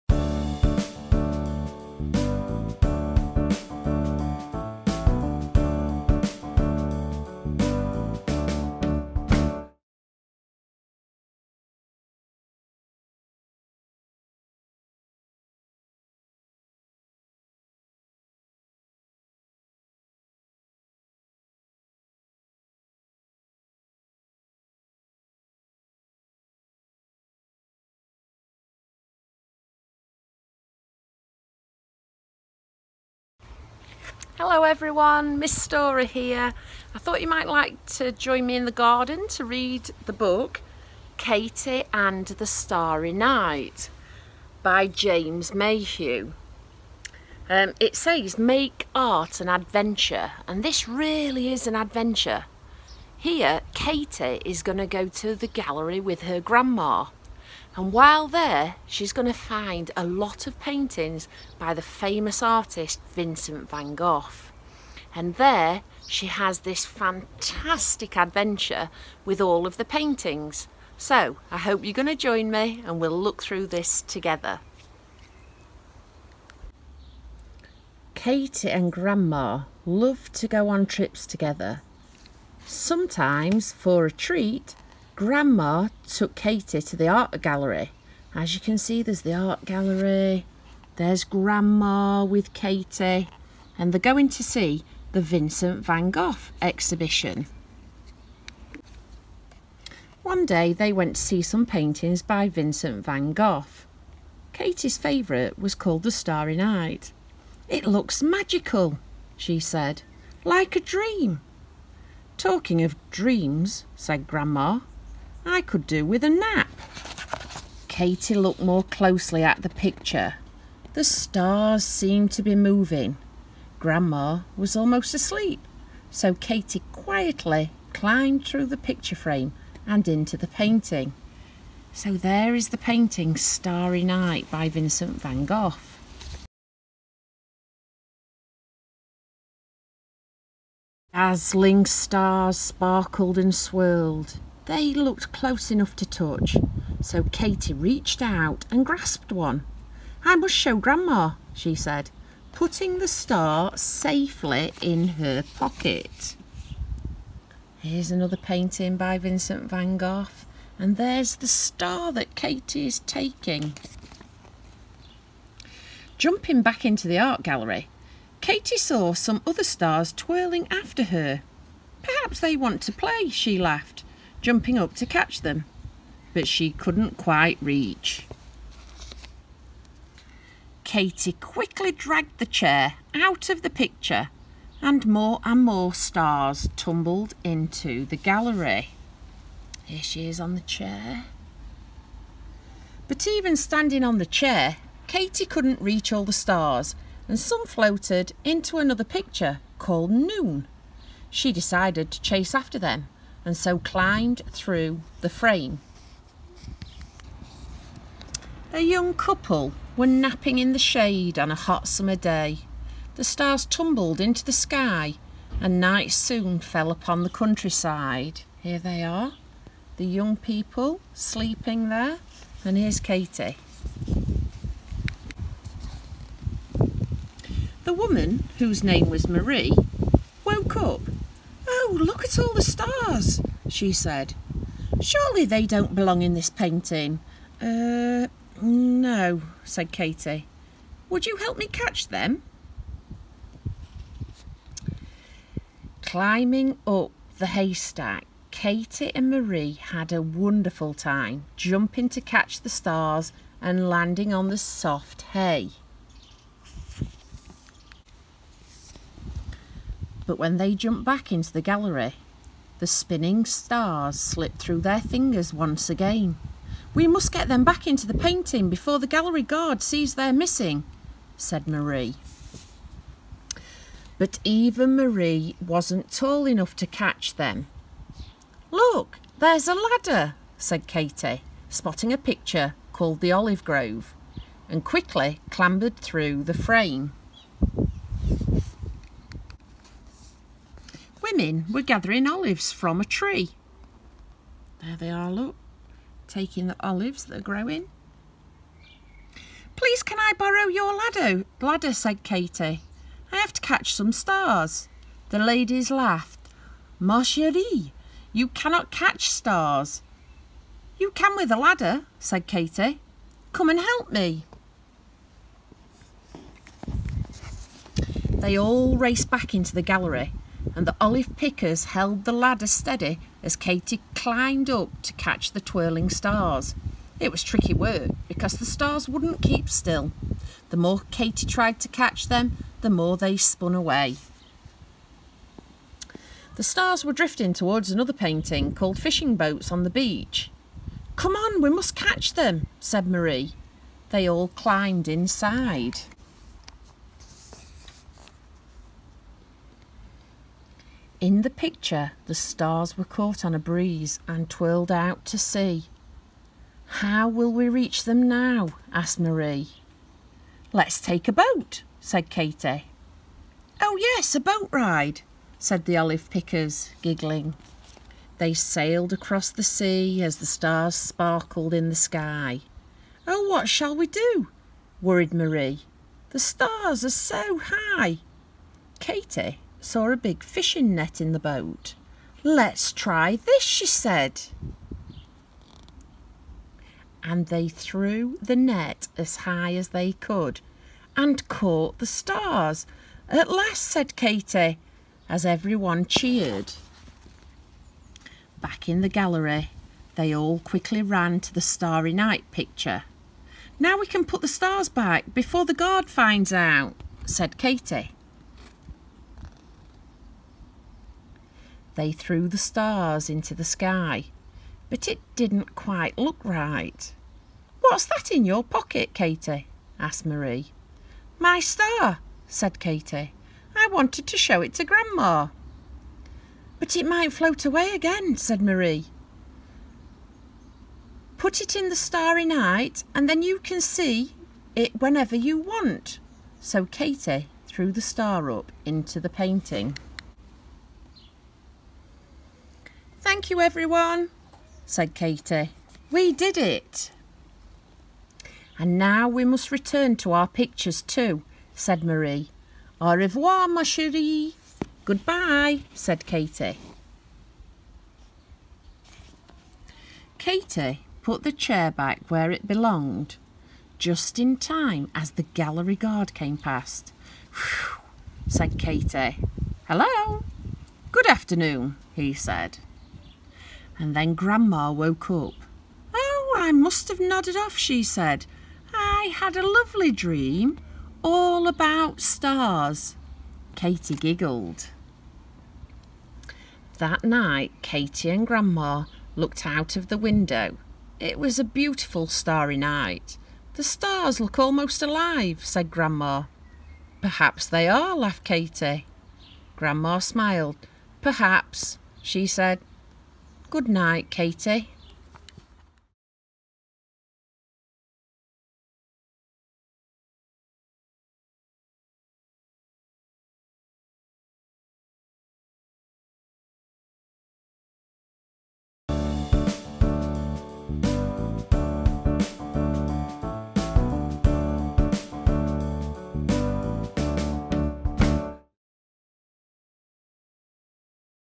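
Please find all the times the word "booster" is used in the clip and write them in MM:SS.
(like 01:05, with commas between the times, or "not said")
not said.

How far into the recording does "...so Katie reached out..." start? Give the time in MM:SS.
02:27.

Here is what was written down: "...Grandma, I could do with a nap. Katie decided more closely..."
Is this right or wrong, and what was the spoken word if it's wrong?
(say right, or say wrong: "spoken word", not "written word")
wrong: "looked", not "decided".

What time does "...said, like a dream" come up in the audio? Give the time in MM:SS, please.
01:49.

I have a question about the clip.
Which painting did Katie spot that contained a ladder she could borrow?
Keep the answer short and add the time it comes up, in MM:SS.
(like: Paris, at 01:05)
The Olive Grove, at 04:43.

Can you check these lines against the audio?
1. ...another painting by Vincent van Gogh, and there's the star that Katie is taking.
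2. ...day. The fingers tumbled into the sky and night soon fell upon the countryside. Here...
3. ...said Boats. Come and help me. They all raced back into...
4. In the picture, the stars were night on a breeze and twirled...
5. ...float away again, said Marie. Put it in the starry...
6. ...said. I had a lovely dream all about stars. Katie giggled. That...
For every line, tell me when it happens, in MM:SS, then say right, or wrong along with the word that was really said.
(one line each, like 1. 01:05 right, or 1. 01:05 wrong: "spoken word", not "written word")
1. 02:38 right
2. 03:32 wrong: "stars", not "fingers"
3. 05:12 wrong: "Katie", not "Boats"
4. 05:51 wrong: "caught", not "night"
5. 07:07 right
6. 07:58 right.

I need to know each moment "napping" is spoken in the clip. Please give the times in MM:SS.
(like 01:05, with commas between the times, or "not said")
03:30.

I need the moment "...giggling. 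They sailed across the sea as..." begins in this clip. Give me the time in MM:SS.
06:07.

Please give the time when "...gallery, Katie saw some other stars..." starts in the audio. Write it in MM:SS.
02:47.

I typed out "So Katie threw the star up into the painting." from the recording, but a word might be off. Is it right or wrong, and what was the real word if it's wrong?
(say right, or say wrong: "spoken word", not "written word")
right.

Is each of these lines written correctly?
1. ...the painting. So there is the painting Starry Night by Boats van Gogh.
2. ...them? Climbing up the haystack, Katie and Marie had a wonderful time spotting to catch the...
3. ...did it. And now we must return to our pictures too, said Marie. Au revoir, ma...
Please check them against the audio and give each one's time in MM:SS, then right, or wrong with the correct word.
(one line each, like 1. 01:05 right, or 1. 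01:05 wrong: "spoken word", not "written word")
1. 02:10 wrong: "Vincent", not "Boats"
2. 04:02 wrong: "jumping", not "spotting"
3. 07:26 right.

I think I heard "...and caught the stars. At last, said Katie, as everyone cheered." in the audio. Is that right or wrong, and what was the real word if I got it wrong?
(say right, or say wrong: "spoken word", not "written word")
right.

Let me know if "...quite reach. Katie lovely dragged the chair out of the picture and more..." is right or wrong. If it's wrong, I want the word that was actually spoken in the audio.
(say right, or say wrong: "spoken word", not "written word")
wrong: "quickly", not "lovely".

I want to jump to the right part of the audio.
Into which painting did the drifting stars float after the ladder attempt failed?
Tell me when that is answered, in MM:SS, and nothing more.
05:38.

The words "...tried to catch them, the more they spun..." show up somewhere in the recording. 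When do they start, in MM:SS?
05:31.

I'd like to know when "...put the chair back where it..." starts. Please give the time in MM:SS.
07:41.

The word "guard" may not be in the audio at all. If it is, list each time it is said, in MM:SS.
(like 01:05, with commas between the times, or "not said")
04:29, 06:45, 07:45.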